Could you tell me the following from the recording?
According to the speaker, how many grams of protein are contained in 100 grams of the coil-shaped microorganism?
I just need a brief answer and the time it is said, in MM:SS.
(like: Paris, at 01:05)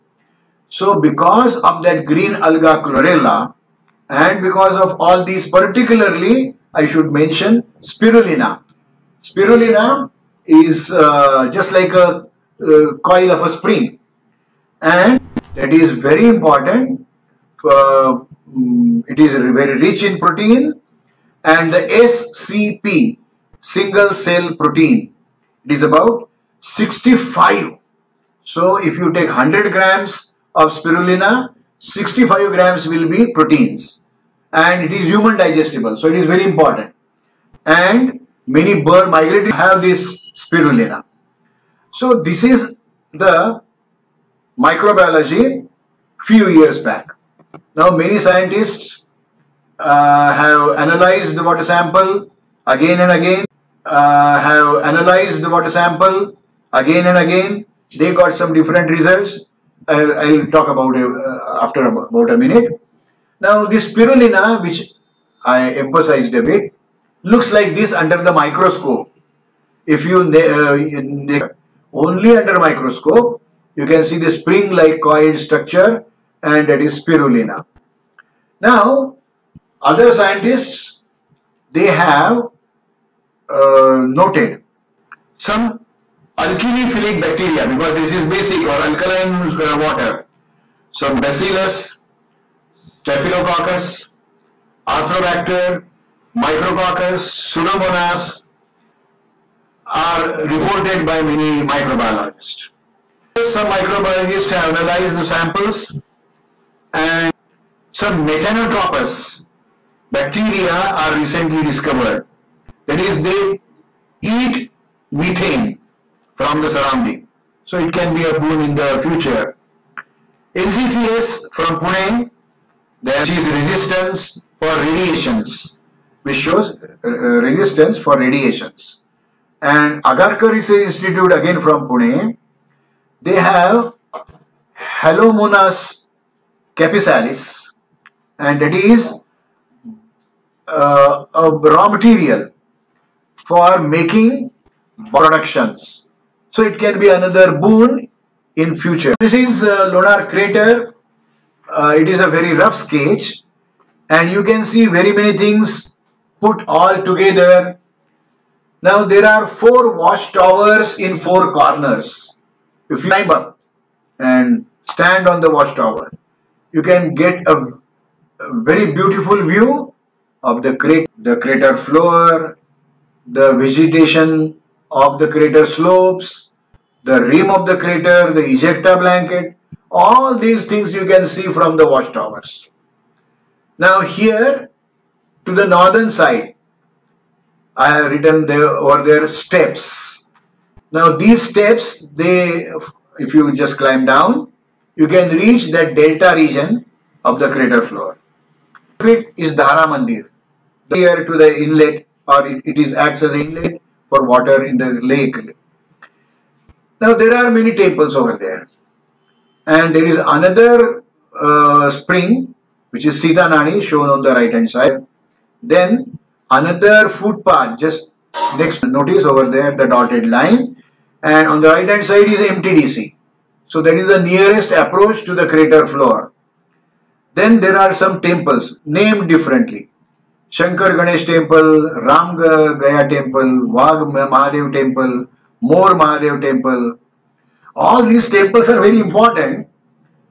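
65, at 00:31.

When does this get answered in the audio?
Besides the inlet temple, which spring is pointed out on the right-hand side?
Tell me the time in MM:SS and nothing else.
03:33.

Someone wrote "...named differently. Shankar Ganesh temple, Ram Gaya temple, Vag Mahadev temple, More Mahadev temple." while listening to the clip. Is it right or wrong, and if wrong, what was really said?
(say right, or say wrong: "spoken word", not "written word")
right.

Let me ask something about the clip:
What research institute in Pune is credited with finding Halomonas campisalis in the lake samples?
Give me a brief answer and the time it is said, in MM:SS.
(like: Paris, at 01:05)
Agarkar Research Institute, at 02:10.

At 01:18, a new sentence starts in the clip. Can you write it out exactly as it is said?
Now, other scientists, they have uh, noted some alkalophilic bacteria because this is basic or alkaline uh, water.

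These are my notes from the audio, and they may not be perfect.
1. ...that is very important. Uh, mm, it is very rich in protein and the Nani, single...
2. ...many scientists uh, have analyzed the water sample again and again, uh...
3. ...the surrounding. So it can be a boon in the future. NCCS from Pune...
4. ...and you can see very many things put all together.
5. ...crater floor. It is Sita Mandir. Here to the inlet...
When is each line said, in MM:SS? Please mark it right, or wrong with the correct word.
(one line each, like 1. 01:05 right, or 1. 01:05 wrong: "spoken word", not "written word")
1. 00:15 wrong: "SCP", not "Nani"
2. 00:47 right
3. 01:56 right
4. 02:34 right
5. 03:17 wrong: "Dhara", not "Sita".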